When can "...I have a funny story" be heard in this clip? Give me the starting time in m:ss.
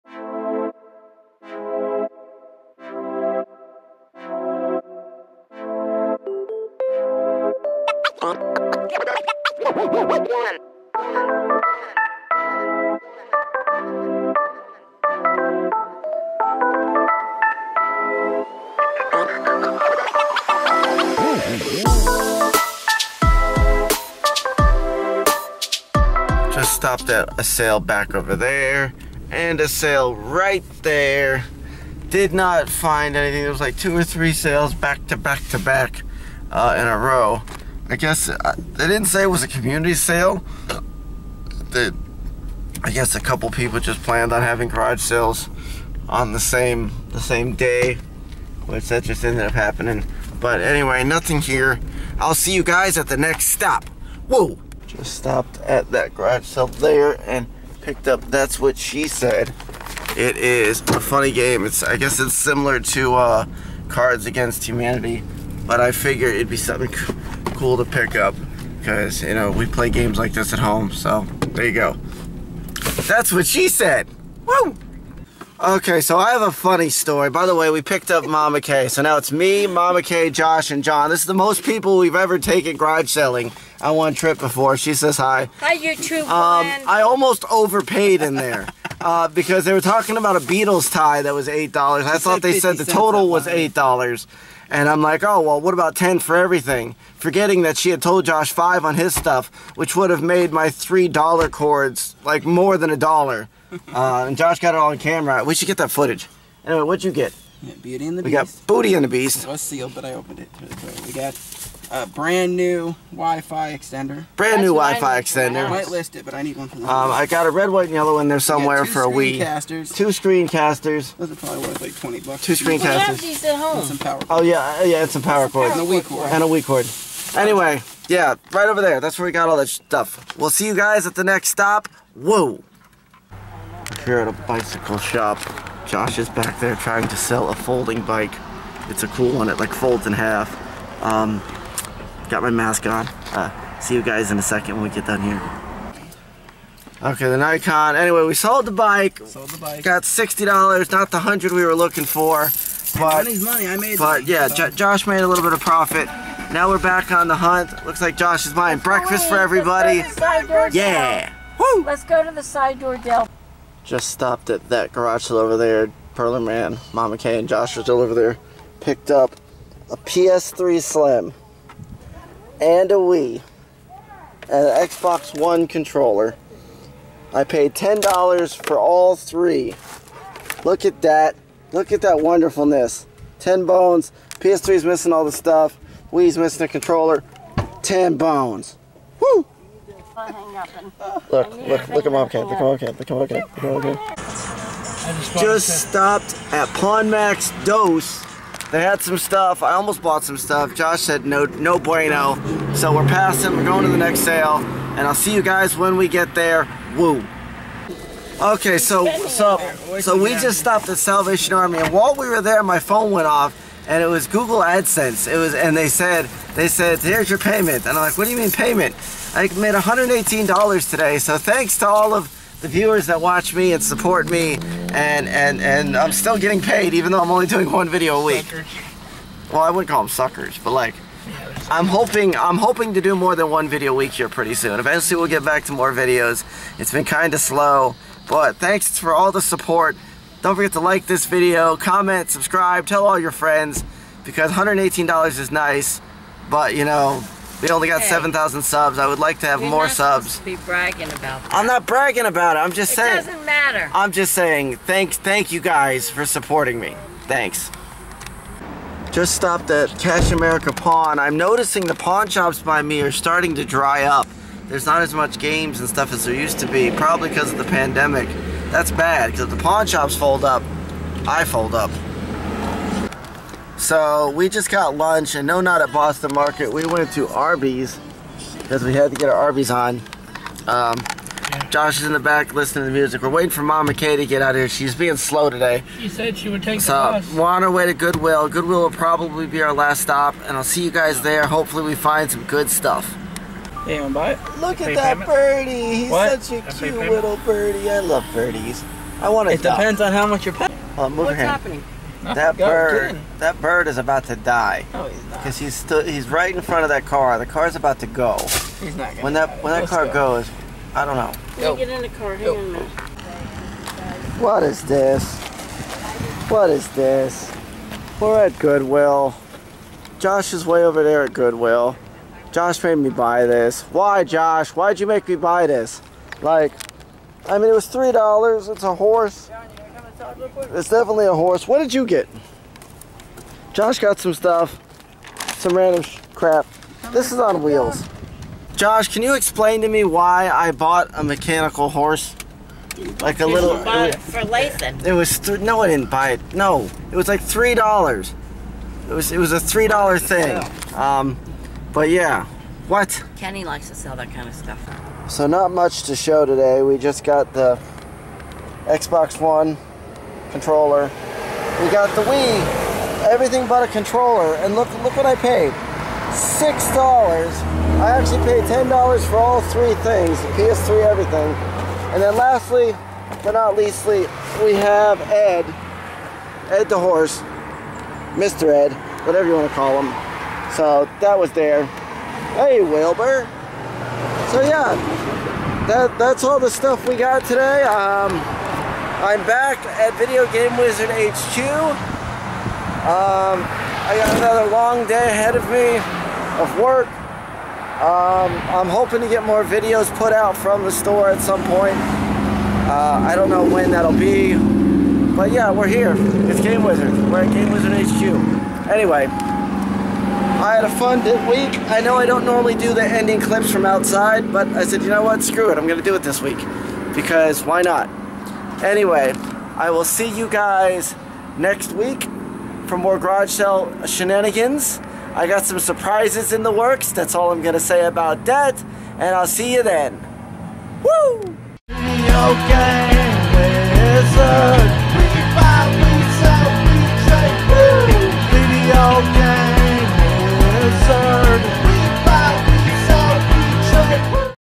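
1:16.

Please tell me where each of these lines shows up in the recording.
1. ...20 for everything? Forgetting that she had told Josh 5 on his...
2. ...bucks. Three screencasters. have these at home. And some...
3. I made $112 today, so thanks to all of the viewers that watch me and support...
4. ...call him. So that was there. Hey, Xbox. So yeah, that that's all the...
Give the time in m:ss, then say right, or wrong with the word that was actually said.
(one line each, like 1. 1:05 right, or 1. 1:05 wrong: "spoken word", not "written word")
1. 1:35 wrong: "10", not "20"
2. 2:02 wrong: "Two", not "Three"
3. 3:39 wrong: "118", not "112"
4. 6:19 wrong: "Wilbur", not "Xbox".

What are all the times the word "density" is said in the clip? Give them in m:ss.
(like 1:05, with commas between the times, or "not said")
not said.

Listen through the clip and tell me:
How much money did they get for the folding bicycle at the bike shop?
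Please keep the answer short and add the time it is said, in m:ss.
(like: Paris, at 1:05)
$60, at 2:30.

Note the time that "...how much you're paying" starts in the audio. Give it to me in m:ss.
5:00.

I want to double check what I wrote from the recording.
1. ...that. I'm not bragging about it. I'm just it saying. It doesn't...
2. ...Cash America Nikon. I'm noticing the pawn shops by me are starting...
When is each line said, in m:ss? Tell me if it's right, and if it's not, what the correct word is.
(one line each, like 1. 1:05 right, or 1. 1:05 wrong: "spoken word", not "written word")
1. 4:11 right
2. 4:19 wrong: "Pawn", not "Nikon".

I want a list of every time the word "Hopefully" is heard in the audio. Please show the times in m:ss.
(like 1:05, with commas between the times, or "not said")
4:51.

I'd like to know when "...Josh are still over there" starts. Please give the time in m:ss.
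2:47.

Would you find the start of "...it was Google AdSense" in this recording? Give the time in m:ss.
3:34.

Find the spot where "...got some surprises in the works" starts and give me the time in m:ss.
7:05.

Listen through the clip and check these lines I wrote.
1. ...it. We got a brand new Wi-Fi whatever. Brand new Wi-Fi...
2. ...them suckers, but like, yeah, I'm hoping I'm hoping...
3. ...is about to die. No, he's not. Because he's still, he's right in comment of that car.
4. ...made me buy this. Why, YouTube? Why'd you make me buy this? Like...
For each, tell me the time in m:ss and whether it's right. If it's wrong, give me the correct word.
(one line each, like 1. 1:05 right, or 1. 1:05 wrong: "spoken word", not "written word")
1. 1:50 wrong: "extender", not "whatever"
2. 3:50 right
3. 5:03 wrong: "front", not "comment"
4. 5:22 wrong: "Josh", not "YouTube".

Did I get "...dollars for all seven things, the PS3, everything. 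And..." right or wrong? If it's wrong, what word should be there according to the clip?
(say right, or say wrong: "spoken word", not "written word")
wrong: "three", not "seven".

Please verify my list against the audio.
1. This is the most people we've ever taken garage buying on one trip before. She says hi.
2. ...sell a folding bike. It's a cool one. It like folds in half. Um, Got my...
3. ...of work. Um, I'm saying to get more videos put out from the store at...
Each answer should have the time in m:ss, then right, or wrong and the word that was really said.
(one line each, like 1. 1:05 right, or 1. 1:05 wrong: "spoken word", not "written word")
1. 1:21 wrong: "selling", not "buying"
2. 2:17 right
3. 6:36 wrong: "hoping", not "saying".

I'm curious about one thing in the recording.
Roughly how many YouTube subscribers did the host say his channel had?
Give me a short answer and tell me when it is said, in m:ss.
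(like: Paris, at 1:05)
7,000, at 4:08.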